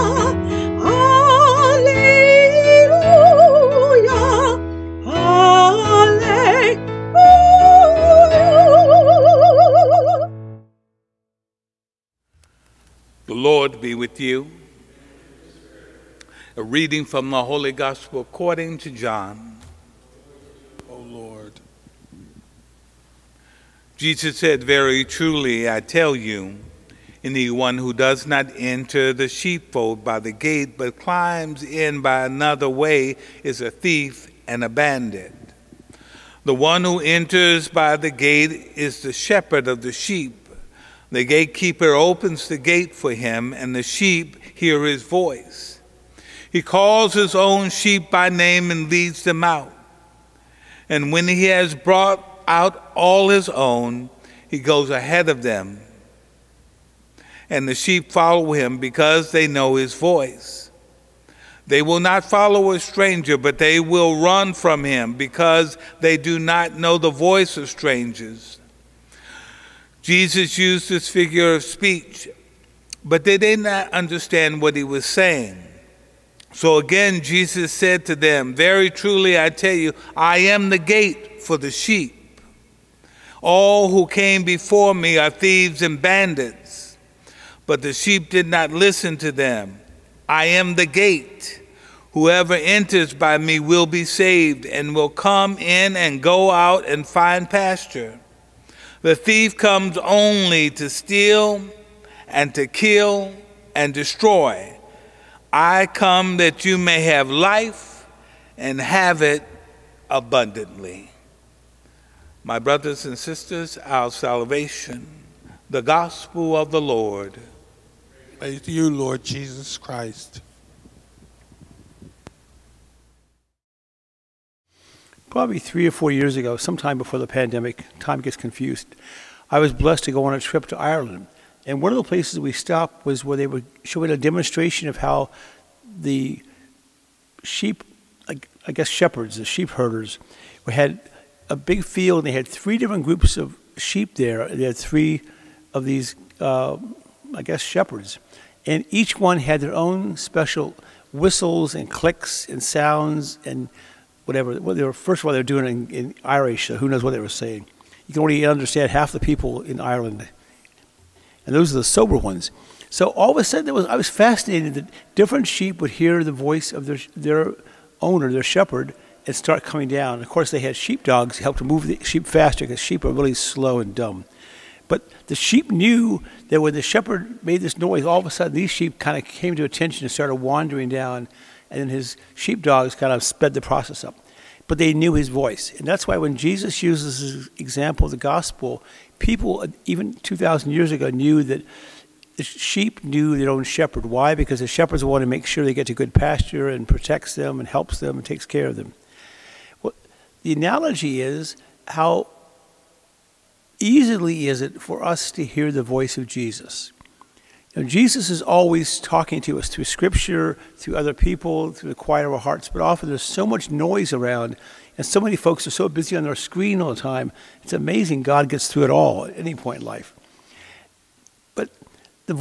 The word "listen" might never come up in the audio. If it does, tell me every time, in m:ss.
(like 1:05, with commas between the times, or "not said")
1:28.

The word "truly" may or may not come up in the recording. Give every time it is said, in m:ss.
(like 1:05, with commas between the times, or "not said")
0:25, 1:18.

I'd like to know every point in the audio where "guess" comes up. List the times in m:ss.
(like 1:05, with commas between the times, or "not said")
2:18, 2:27.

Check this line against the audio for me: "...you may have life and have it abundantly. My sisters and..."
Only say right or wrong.
wrong.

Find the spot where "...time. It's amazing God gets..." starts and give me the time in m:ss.
3:36.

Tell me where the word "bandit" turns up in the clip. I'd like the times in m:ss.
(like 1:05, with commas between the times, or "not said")
0:34, 1:26.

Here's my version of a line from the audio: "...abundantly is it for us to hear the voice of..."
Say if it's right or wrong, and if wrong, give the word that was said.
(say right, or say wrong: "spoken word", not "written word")
wrong: "easily", not "abundantly".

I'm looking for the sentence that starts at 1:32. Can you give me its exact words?
Whoever enters by me will be saved and will come in and go out and find pasture.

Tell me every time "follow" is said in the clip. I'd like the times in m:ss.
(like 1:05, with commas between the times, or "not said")
0:58, 1:02.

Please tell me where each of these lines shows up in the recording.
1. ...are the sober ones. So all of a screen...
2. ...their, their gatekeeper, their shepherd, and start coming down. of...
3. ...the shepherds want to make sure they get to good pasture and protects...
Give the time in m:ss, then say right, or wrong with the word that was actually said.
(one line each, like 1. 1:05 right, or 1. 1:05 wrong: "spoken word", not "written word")
1. 2:41 wrong: "sudden", not "screen"
2. 2:46 wrong: "owner", not "gatekeeper"
3. 3:14 right.